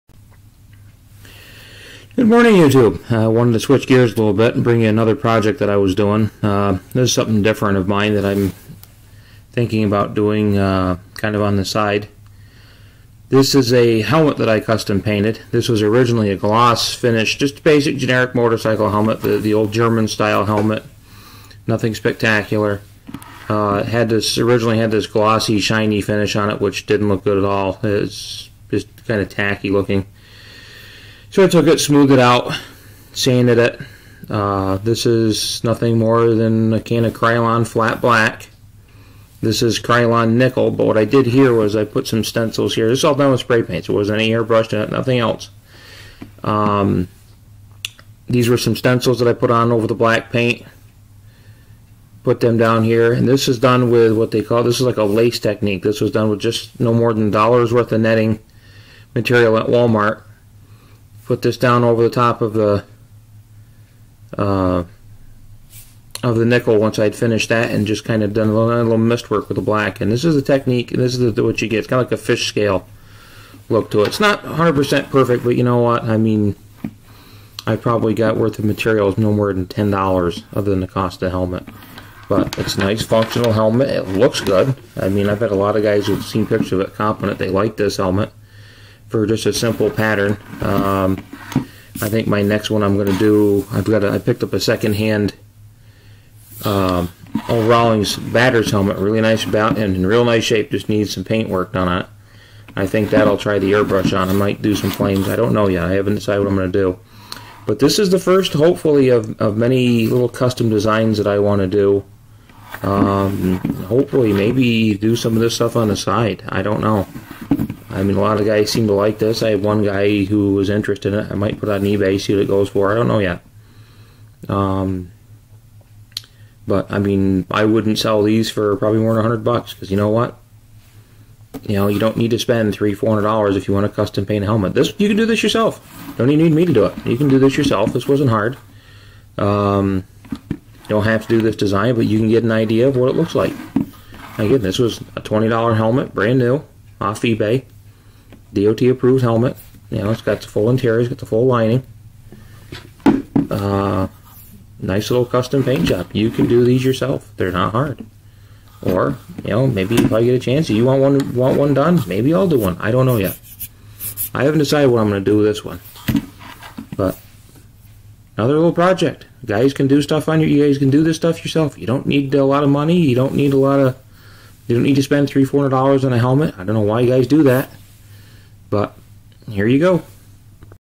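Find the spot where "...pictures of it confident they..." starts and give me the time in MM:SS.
01:26.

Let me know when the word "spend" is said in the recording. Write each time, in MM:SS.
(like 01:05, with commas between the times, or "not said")
02:12, 02:55.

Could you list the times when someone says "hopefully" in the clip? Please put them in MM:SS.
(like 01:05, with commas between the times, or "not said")
01:48, 01:53.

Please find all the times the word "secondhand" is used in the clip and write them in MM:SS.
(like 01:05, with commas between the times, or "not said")
01:34.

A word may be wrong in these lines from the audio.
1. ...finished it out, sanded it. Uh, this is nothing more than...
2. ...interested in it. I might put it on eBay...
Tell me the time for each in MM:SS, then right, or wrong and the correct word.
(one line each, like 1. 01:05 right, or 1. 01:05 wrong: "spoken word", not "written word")
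1. 00:31 wrong: "smoothed", not "finished"
2. 02:00 right.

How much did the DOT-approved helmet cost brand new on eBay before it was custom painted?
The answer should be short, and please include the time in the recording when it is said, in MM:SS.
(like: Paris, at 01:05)
$20, at 02:25.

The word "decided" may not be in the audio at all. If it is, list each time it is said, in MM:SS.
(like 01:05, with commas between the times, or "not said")
01:46, 02:44.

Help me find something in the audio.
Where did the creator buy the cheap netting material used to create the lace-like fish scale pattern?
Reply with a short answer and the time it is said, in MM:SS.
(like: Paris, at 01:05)
Walmart, at 00:59.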